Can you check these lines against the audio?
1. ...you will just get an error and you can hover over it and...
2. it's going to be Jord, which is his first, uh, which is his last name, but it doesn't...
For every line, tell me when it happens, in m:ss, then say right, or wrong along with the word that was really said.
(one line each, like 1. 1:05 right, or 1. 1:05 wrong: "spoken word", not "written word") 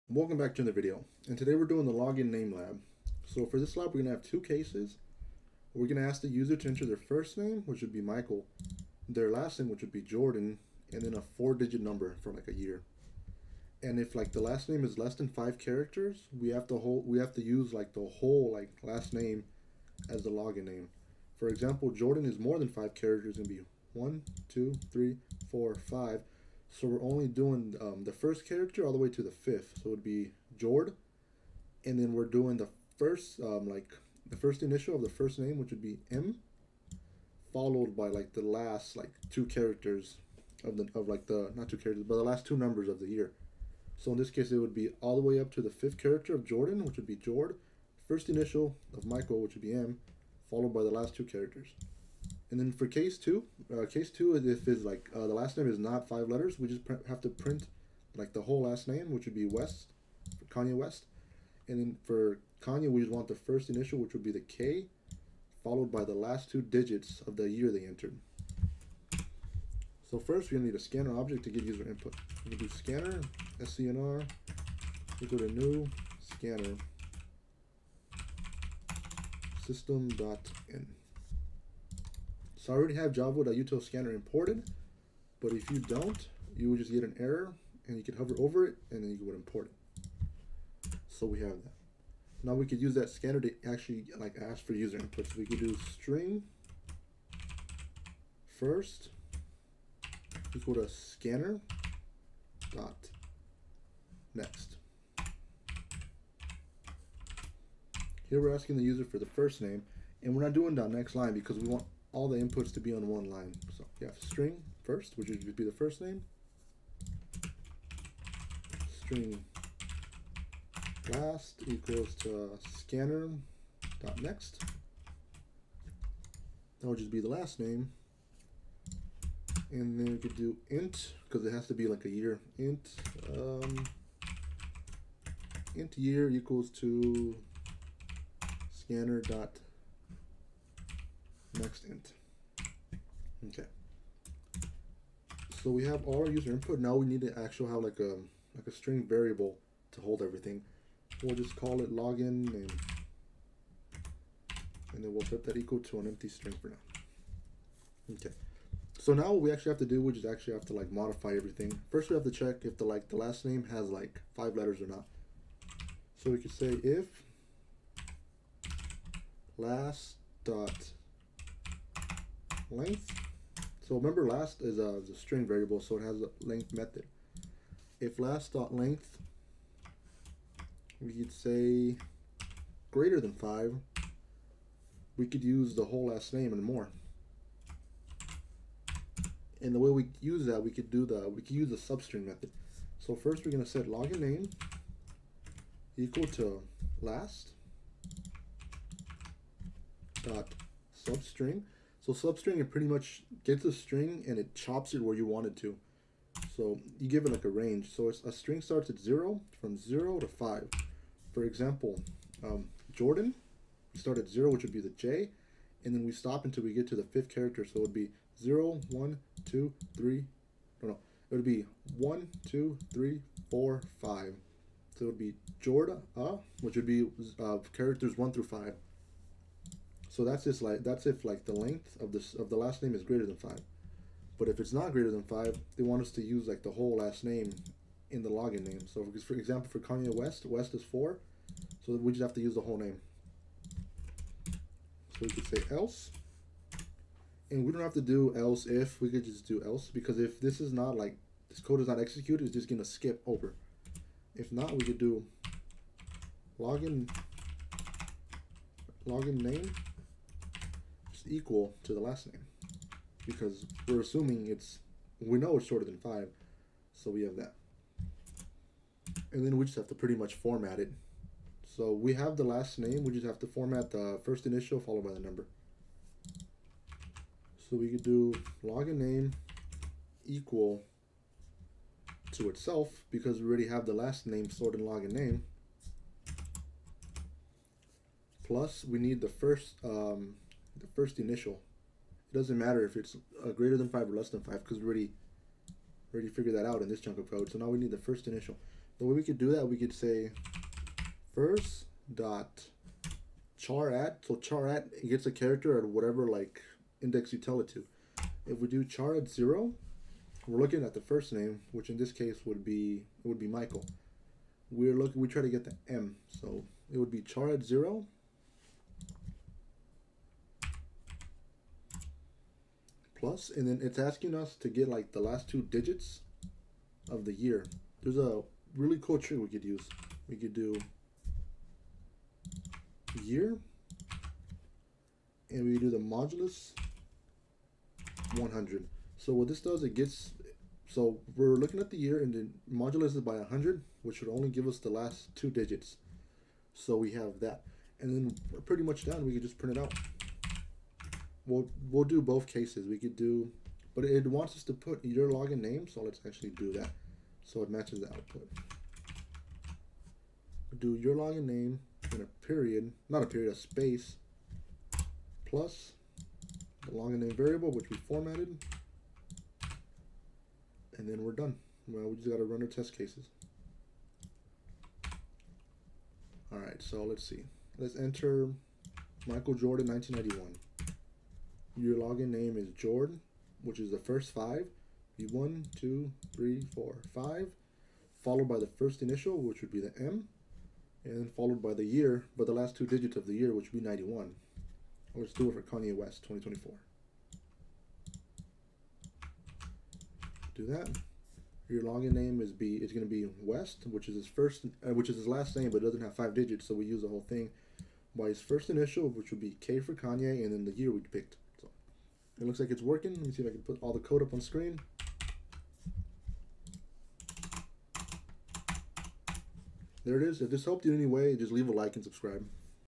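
1. 1:26 right
2. 6:42 wrong: "West", not "Jord".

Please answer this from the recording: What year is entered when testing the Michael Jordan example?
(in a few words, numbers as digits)
1991.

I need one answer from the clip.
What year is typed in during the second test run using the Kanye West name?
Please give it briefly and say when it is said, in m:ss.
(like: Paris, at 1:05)
2024, at 6:36.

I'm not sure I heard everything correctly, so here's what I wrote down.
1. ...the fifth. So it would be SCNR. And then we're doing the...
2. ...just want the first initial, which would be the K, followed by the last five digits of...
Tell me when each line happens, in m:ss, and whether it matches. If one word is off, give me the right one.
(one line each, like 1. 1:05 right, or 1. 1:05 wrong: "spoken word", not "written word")
1. 0:29 wrong: "Jord", not "SCNR"
2. 1:03 wrong: "two", not "five".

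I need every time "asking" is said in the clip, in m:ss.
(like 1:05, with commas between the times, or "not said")
1:48, 5:23.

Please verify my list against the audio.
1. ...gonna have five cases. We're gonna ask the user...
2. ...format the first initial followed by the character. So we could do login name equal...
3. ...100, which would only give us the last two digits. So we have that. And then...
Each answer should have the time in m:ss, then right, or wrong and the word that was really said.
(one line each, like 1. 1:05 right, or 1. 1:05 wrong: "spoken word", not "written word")
1. 0:04 wrong: "two", not "five"
2. 4:33 wrong: "number", not "character"
3. 5:43 right.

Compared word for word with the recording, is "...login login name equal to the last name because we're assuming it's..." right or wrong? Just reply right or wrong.
right.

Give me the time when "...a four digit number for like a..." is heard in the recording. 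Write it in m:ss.
0:11.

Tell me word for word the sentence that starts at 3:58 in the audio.
So for, example, for Kanye West, West is four, so we just have to use the whole name.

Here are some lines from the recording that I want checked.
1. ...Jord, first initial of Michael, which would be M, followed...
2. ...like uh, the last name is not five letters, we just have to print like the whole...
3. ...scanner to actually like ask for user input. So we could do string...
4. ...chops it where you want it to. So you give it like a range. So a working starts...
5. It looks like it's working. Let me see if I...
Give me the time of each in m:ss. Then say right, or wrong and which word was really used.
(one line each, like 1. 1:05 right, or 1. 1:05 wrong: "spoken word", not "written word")
1. 0:47 right
2. 0:54 right
3. 1:33 right
4. 3:24 wrong: "string", not "working"
5. 6:52 right.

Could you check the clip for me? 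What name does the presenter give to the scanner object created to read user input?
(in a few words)
SCNR.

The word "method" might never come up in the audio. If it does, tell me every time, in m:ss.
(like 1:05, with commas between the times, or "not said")
2:56, 3:12.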